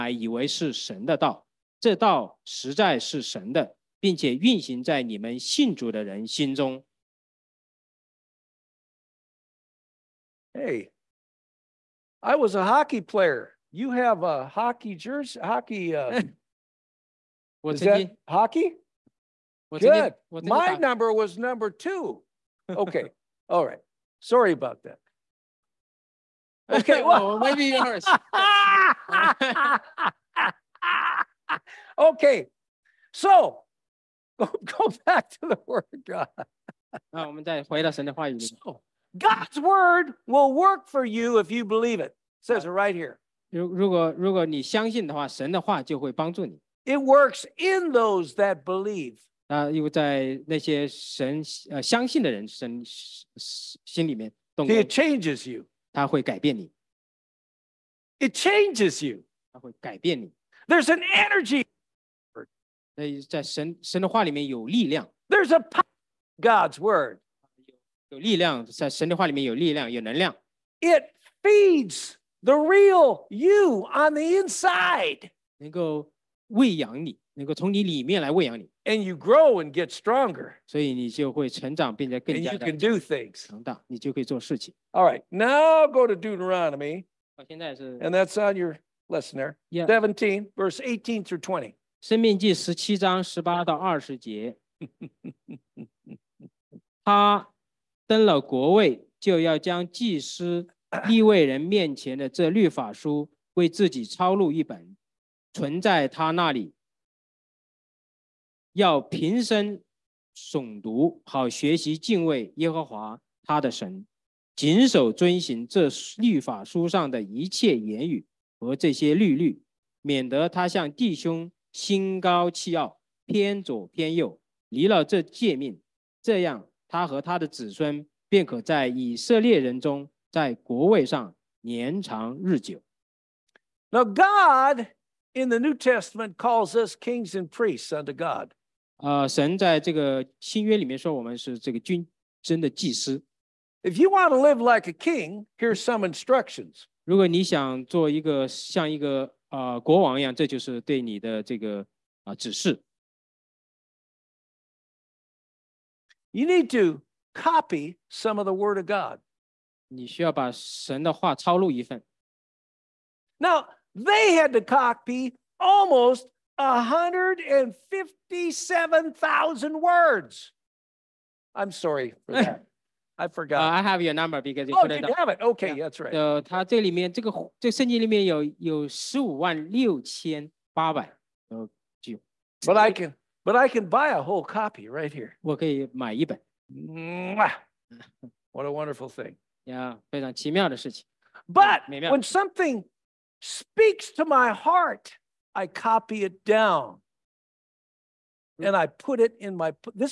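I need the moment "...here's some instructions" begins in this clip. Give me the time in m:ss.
2:25.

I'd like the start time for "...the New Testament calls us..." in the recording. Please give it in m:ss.
2:15.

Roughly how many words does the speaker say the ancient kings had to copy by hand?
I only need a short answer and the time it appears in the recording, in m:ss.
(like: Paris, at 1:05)
157,000, at 2:46.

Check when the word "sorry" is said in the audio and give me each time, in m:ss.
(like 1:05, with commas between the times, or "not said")
0:24, 2:51.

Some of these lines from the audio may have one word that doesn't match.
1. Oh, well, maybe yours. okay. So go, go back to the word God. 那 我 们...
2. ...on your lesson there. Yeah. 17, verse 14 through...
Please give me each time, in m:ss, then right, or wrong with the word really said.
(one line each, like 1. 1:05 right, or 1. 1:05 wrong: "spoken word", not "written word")
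1. 0:27 right
2. 1:28 wrong: "18", not "14".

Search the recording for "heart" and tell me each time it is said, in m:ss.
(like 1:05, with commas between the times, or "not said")
3:14.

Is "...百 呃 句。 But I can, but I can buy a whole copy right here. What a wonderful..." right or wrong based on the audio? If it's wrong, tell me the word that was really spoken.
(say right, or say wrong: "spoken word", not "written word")
right.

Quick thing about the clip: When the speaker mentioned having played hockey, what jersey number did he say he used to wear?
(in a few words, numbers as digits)
2.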